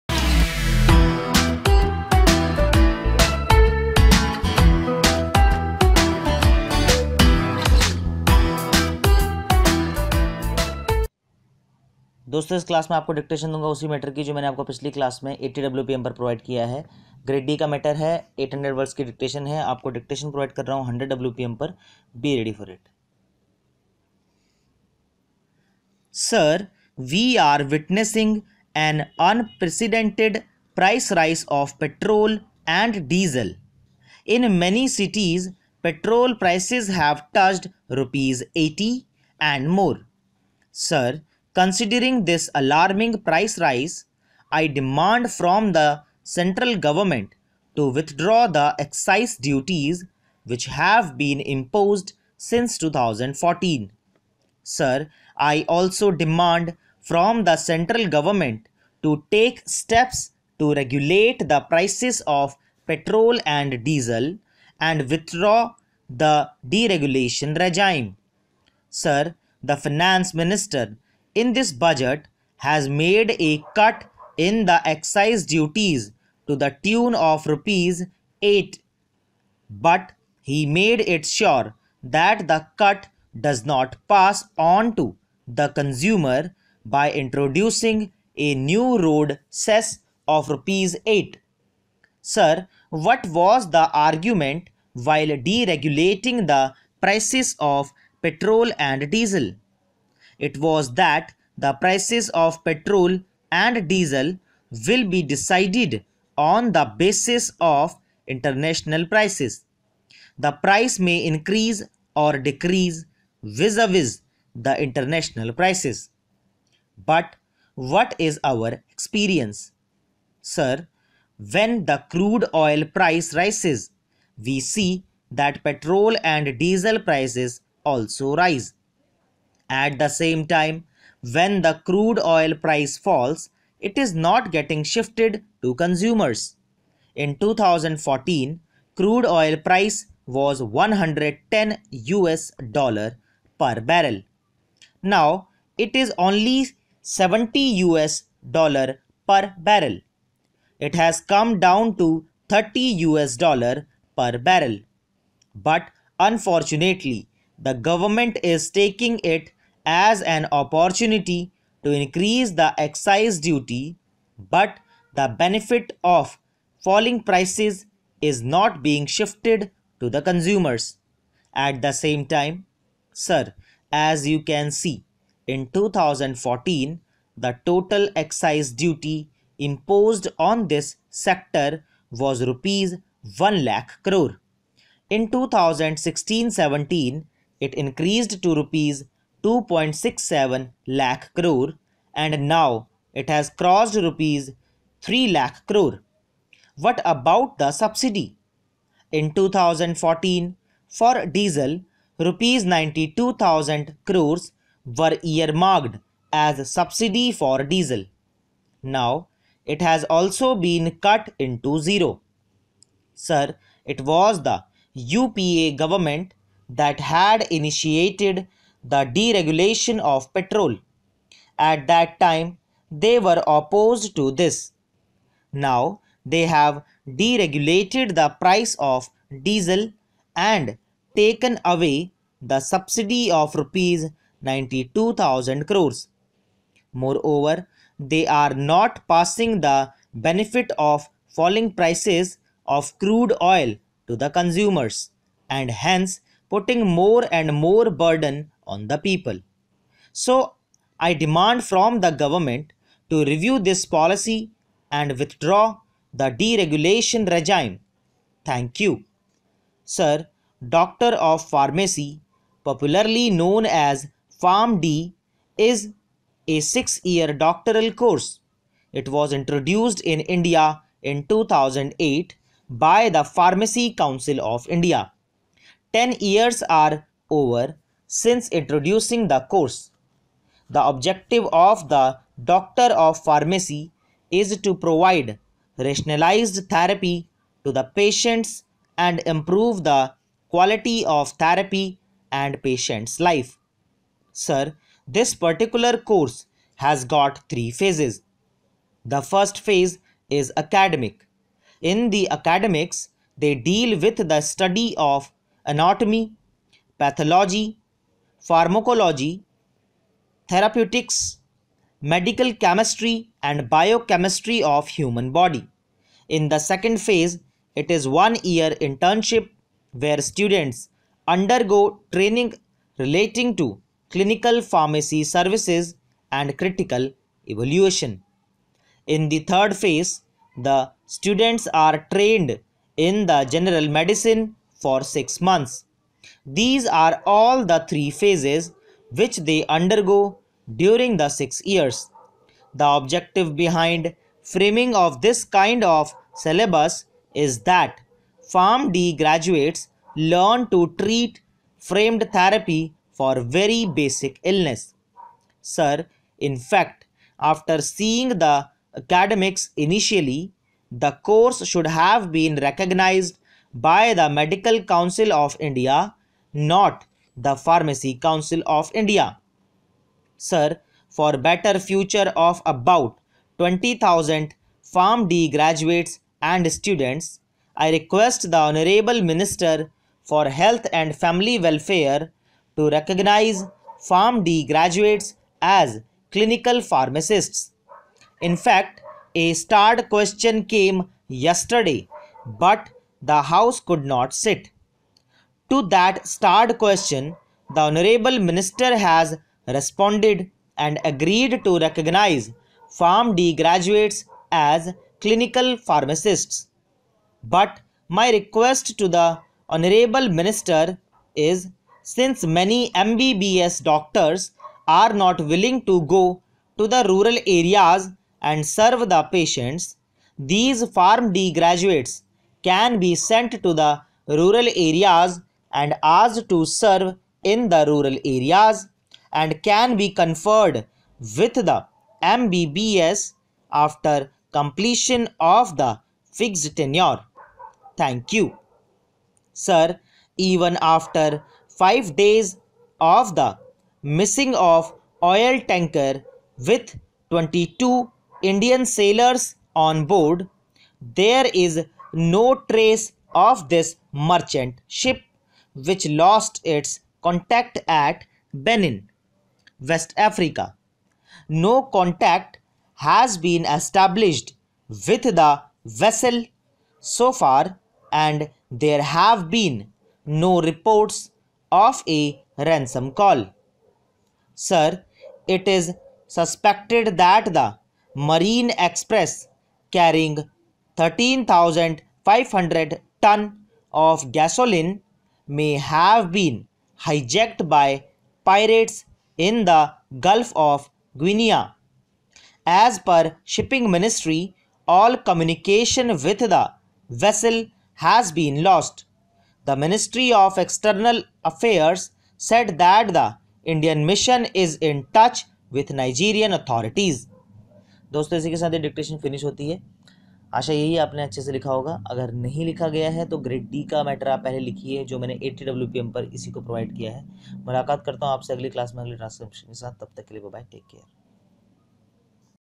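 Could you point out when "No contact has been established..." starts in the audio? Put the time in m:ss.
7:41.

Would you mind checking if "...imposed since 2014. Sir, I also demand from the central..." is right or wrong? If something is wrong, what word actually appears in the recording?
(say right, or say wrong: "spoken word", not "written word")
right.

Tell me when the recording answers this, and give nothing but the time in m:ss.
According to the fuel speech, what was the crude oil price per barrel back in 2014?
2:20.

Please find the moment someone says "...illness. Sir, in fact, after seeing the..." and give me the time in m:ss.
5:54.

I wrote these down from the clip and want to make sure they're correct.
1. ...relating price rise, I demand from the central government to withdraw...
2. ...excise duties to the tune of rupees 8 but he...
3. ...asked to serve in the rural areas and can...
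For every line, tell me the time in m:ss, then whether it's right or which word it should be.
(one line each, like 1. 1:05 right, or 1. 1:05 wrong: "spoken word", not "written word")
1. 0:42 wrong: "alarming", not "relating"
2. 1:14 right
3. 7:06 right.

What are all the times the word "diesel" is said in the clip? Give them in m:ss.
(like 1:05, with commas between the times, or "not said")
1:03, 1:39, 1:43, 2:06, 3:21, 3:27, 3:49.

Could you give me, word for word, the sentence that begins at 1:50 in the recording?
The price may increase or decrease vis-a-vis -vis the international prices.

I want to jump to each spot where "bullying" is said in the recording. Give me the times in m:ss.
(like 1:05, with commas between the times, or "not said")
not said.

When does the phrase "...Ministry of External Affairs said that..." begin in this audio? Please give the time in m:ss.
8:19.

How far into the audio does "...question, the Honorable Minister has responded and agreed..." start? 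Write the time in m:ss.
6:36.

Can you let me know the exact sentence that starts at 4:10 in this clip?
So, I demand from the government to review this policy and withdraw the deregulation regime.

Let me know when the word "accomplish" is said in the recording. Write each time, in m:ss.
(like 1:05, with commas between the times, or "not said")
not said.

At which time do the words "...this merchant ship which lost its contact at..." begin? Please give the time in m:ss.
7:33.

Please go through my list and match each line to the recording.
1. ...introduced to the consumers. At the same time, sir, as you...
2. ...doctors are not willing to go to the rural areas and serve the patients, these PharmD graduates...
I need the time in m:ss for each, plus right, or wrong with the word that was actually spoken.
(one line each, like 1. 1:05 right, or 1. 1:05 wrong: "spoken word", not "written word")
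1. 2:49 wrong: "shifted", not "introduced"
2. 6:53 right.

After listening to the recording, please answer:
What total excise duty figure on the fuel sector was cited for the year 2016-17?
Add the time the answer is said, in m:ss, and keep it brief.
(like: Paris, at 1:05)
Rs 2.67 lakh crore, at 3:08.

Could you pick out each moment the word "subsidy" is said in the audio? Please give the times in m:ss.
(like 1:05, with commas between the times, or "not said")
3:17, 3:26, 3:52.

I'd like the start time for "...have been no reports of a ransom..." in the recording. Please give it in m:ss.
7:49.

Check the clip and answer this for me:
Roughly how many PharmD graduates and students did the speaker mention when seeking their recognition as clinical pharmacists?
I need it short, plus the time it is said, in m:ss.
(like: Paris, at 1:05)
20,000, at 6:13.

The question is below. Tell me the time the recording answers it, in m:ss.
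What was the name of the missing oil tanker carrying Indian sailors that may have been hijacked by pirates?
7:58.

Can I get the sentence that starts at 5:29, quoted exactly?
In the third phase, the students are trained in the general medicine for 6 months.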